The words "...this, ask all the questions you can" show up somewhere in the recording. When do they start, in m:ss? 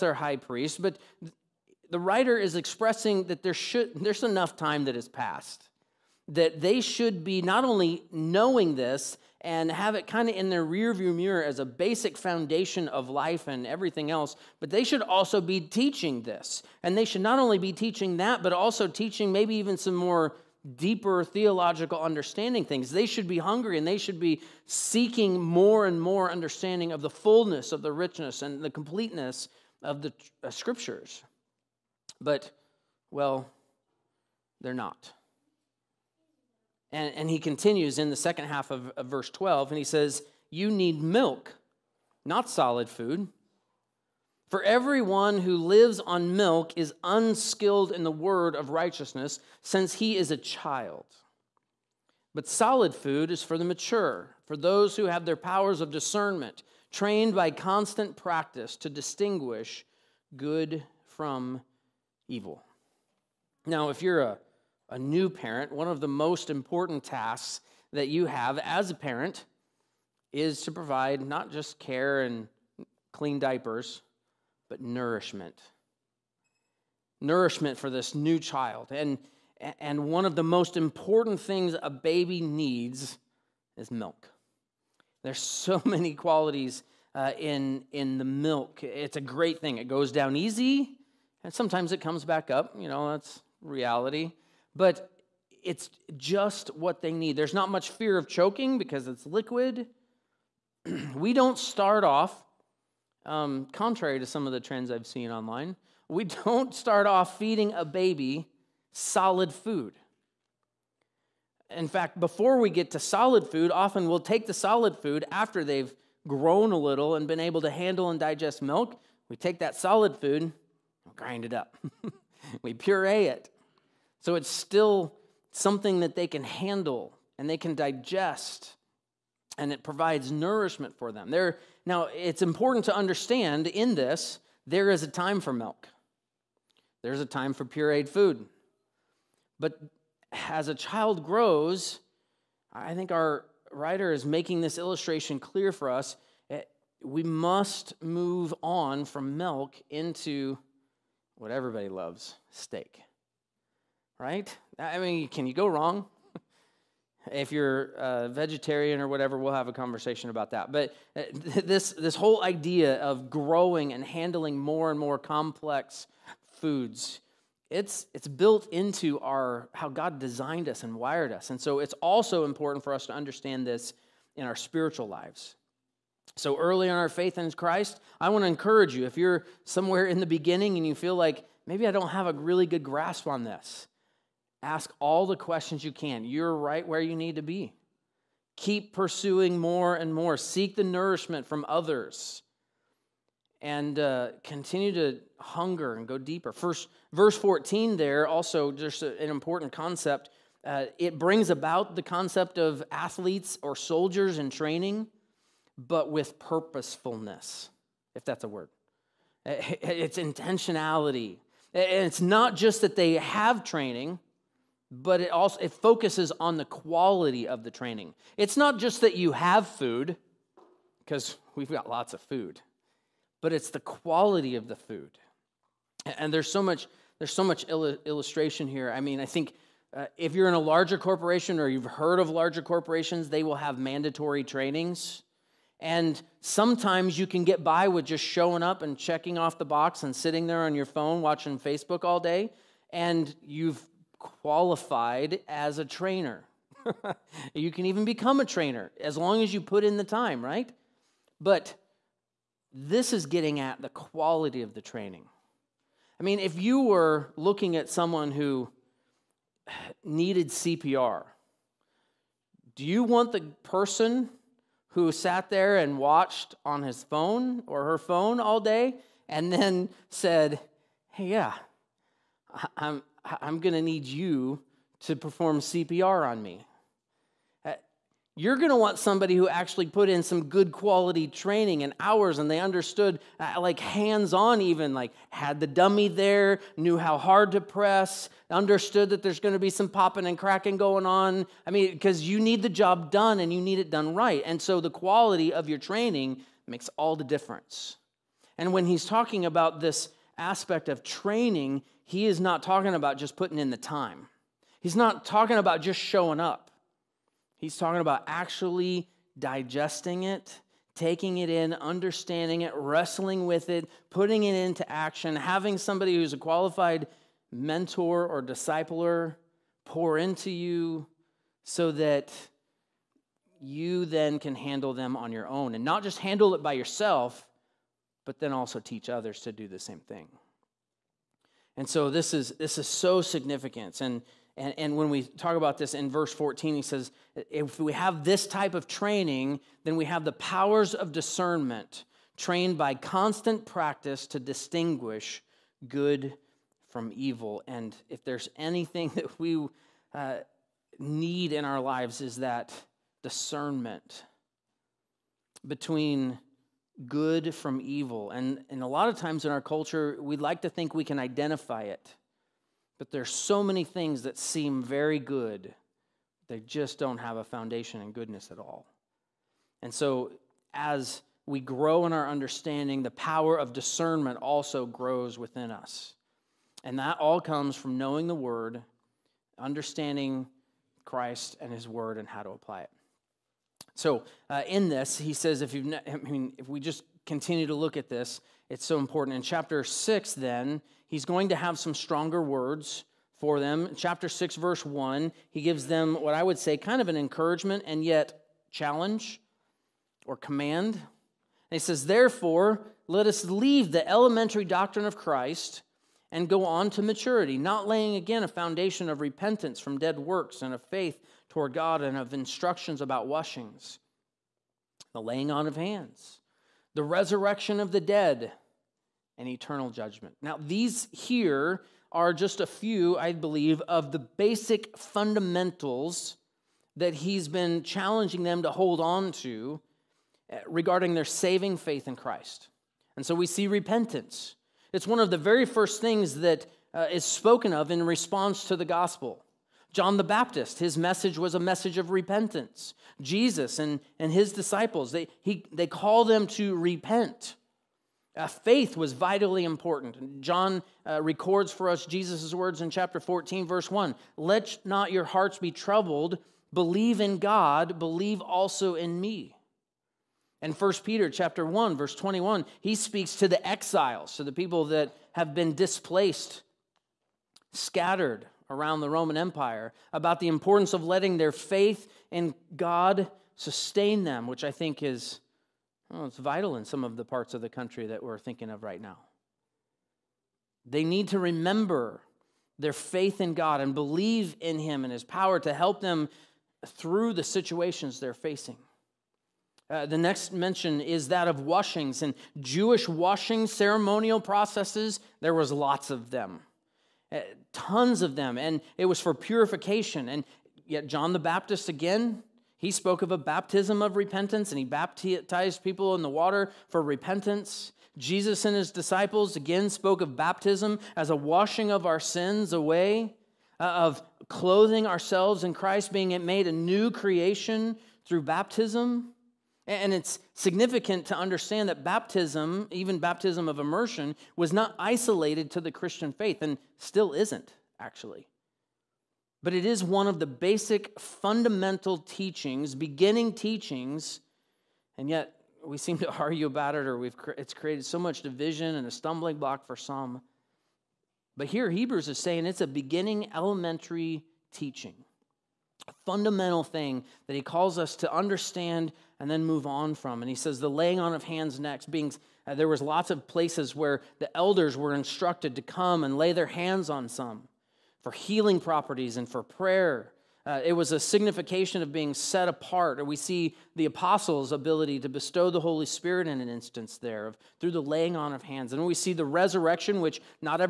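3:03.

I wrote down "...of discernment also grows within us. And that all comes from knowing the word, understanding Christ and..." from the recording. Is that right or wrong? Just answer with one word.
right.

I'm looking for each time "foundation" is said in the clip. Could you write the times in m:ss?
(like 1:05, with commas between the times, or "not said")
0:12, 6:07, 6:48.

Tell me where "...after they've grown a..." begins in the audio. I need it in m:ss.
1:55.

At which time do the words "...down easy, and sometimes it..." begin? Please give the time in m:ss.
1:30.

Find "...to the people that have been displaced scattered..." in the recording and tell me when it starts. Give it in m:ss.
7:44.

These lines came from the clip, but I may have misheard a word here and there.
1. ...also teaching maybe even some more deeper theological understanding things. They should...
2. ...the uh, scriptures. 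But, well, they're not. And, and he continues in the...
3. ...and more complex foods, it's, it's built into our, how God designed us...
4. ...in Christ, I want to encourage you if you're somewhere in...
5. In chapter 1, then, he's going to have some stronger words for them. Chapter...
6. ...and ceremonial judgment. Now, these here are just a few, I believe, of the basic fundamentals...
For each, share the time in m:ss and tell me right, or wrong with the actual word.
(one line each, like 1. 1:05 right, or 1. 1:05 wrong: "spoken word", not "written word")
1. 0:18 right
2. 0:30 right
3. 2:44 right
4. 2:57 right
5. 6:29 wrong: "6", not "1"
6. 6:59 wrong: "eternal", not "ceremonial".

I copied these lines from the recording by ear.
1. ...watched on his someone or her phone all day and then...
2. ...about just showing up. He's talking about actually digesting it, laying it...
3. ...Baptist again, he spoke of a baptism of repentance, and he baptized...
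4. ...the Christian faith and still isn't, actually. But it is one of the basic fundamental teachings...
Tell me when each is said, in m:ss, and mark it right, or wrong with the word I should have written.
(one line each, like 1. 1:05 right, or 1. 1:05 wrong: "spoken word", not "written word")
1. 4:25 wrong: "phone", not "someone"
2. 5:05 wrong: "taking", not "laying"
3. 8:21 right
4. 8:45 right.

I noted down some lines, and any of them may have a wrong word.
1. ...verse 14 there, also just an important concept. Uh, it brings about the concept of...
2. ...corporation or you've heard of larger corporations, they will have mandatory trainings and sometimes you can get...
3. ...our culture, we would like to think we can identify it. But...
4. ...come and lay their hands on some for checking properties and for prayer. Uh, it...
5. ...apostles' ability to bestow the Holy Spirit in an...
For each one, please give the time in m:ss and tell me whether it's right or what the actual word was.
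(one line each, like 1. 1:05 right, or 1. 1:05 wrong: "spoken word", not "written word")
1. 3:17 right
2. 3:50 right
3. 5:59 right
4. 9:15 wrong: "healing", not "checking"
5. 9:24 right.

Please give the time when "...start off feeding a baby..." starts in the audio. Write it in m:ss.
1:46.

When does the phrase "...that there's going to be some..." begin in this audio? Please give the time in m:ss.
4:49.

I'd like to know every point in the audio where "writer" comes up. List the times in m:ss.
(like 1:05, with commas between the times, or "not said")
0:01, 2:23.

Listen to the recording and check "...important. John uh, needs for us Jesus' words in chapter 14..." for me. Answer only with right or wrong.
wrong.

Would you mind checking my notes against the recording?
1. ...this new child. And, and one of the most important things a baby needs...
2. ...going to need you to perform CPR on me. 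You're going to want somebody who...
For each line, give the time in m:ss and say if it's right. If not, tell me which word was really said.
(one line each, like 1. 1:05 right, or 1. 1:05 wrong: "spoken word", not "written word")
1. 1:17 right
2. 4:33 right.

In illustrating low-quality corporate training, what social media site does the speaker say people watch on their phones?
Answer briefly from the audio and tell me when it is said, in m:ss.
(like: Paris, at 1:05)
Facebook, at 4:01.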